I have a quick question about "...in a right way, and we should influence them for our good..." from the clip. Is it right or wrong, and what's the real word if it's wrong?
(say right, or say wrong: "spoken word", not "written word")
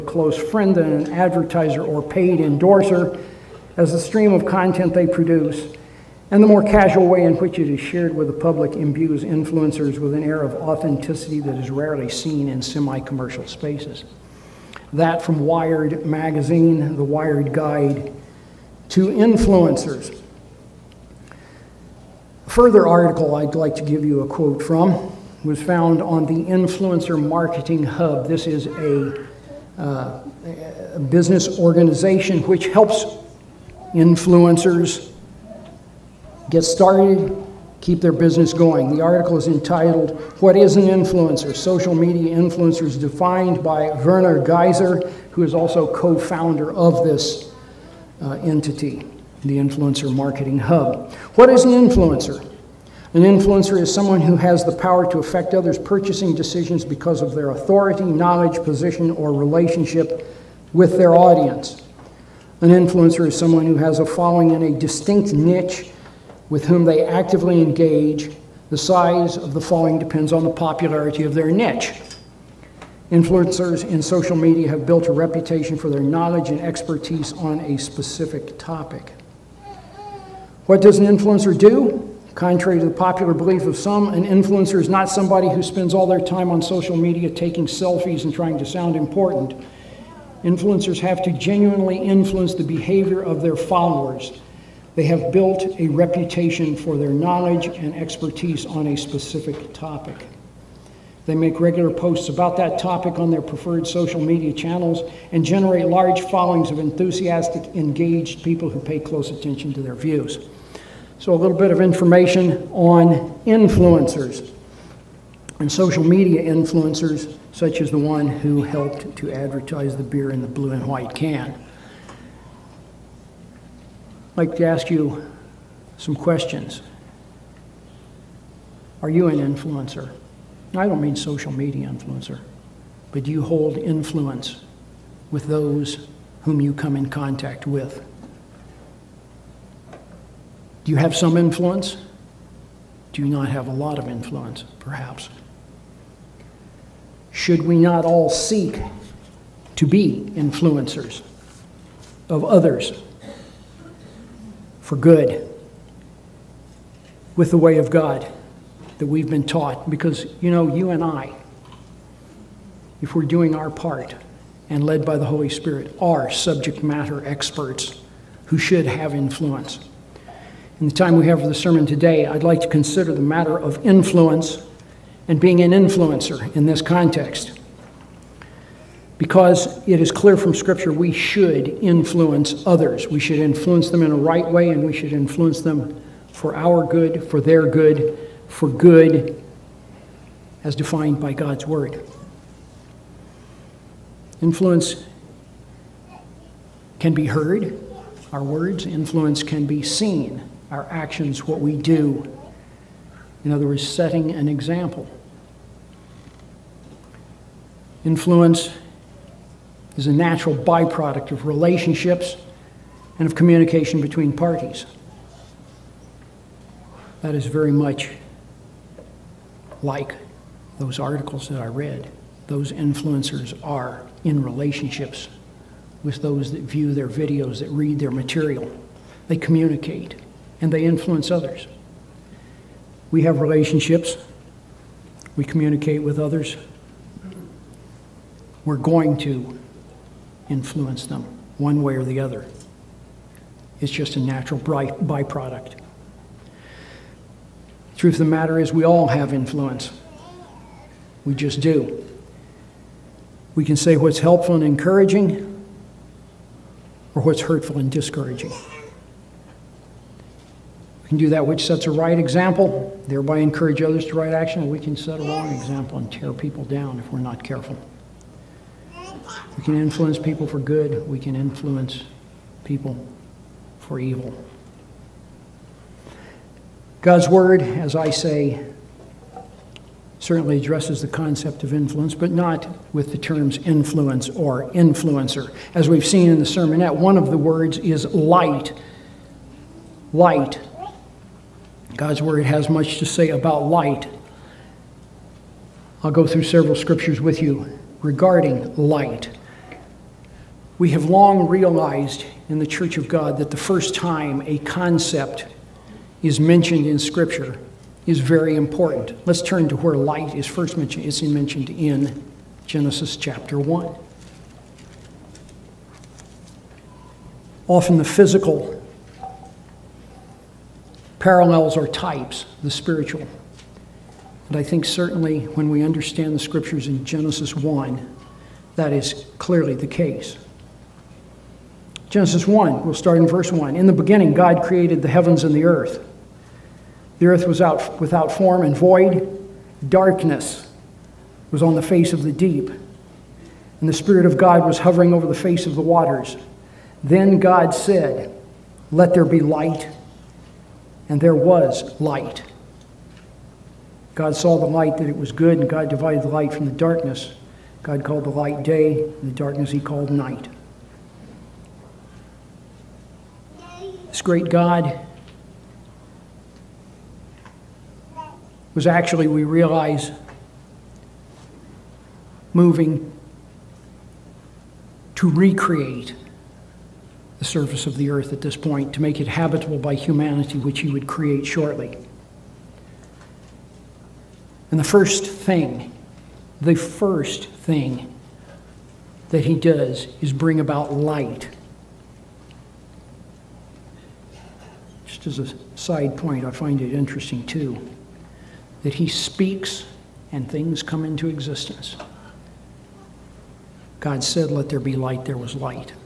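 right.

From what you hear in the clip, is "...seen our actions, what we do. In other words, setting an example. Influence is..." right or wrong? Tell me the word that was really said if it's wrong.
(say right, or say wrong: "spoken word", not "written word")
right.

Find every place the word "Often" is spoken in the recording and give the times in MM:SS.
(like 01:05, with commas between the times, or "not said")
05:17.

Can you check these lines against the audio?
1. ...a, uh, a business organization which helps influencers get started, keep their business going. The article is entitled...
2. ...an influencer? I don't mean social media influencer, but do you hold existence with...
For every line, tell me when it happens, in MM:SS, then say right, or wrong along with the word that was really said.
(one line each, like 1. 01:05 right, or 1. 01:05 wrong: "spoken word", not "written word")
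1. 00:28 right
2. 02:09 wrong: "influence", not "existence".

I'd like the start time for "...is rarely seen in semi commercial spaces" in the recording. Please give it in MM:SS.
00:11.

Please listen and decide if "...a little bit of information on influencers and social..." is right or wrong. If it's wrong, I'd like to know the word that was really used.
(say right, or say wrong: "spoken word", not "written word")
right.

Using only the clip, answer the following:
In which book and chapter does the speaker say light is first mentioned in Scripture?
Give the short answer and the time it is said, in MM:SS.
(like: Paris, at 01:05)
Genesis 1, at 05:12.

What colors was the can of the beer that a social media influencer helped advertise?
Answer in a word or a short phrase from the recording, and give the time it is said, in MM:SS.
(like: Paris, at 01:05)
Blue and white, at 02:00.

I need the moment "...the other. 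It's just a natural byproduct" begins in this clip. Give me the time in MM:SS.
04:02.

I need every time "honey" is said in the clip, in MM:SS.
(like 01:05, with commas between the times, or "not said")
not said.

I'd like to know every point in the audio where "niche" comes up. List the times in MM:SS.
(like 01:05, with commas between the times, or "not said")
01:05, 01:11.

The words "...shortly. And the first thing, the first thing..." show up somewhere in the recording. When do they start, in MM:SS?
06:21.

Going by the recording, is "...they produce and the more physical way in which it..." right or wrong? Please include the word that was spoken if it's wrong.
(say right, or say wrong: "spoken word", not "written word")
wrong: "casual", not "physical".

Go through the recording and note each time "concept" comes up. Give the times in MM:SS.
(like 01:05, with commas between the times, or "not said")
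04:41, 05:04.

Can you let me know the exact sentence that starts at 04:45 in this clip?
As we've seen in the sermonette, one of the words is light.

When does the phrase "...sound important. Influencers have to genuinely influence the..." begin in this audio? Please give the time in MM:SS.
01:28.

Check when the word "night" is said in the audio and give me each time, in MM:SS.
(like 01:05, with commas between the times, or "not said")
06:00.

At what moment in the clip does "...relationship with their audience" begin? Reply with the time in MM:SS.
00:59.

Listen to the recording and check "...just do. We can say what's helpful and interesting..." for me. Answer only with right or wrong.
wrong.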